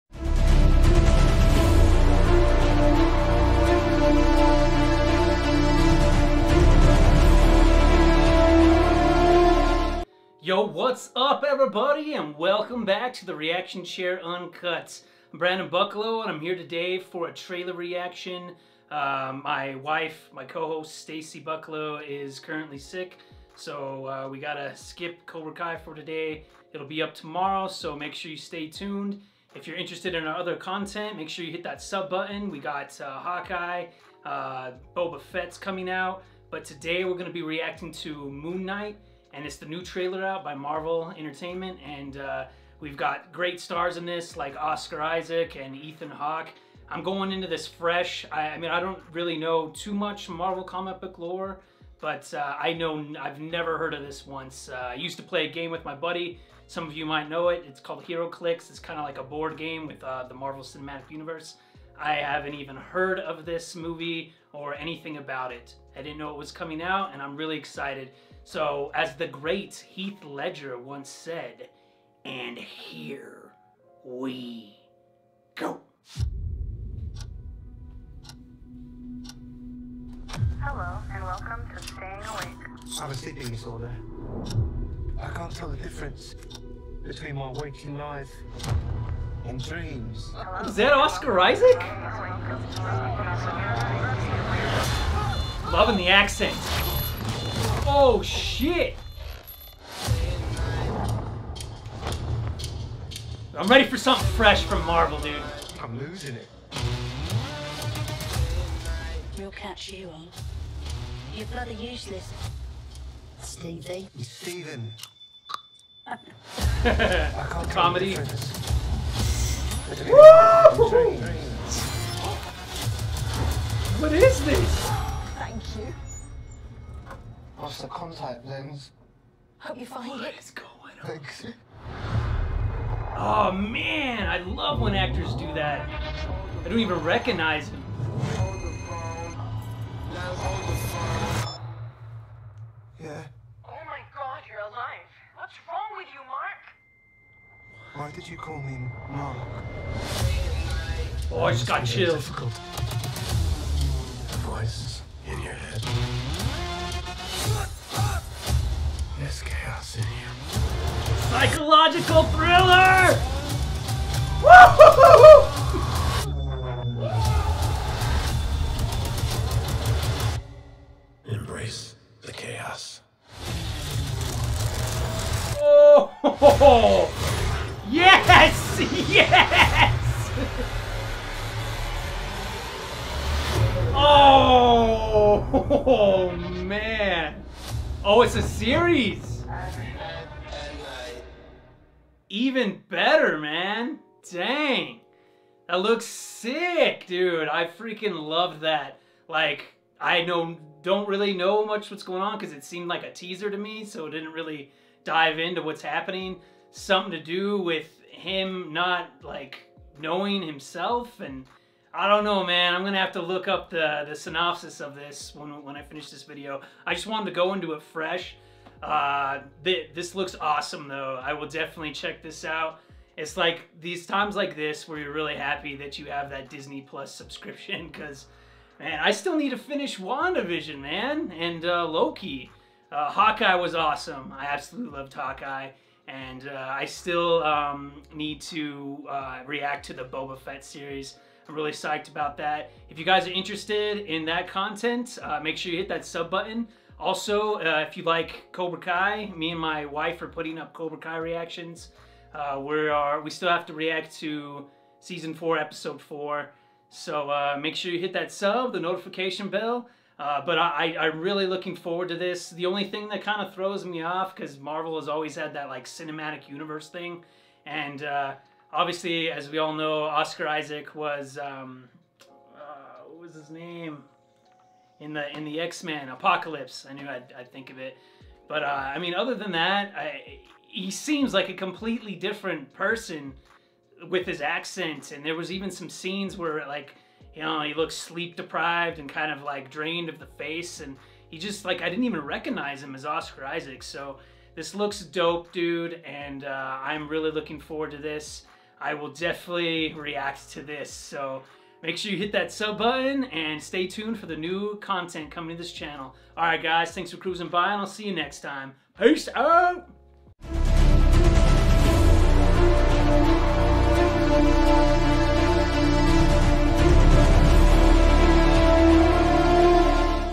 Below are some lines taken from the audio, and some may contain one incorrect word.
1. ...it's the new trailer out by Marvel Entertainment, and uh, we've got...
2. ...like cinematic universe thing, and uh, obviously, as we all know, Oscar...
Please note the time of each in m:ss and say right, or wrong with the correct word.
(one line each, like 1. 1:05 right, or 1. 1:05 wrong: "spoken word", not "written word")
1. 0:39 right
2. 4:25 right.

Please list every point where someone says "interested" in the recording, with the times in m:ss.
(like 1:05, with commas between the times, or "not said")
0:29, 4:03.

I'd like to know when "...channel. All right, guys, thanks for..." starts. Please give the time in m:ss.
5:05.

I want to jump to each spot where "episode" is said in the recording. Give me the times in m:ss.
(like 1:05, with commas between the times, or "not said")
4:15.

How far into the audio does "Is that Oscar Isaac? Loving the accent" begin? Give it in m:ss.
1:30.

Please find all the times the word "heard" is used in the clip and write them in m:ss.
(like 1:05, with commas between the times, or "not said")
0:53, 1:02.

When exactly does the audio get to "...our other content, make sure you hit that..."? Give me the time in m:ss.
0:30.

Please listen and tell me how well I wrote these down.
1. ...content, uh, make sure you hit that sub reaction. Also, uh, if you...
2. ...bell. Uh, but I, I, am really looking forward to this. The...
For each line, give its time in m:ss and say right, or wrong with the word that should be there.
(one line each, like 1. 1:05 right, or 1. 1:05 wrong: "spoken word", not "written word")
1. 4:04 wrong: "button", not "reaction"
2. 4:19 right.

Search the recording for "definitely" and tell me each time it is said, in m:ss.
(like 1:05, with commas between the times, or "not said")
3:41, 4:59.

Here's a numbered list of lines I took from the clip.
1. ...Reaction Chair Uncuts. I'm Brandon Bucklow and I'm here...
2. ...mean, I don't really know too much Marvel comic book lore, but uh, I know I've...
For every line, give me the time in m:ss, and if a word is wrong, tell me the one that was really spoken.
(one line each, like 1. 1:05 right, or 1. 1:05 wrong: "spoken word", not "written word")
1. 0:13 right
2. 0:48 right.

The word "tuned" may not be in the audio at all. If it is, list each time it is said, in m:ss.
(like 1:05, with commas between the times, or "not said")
0:28, 5:03.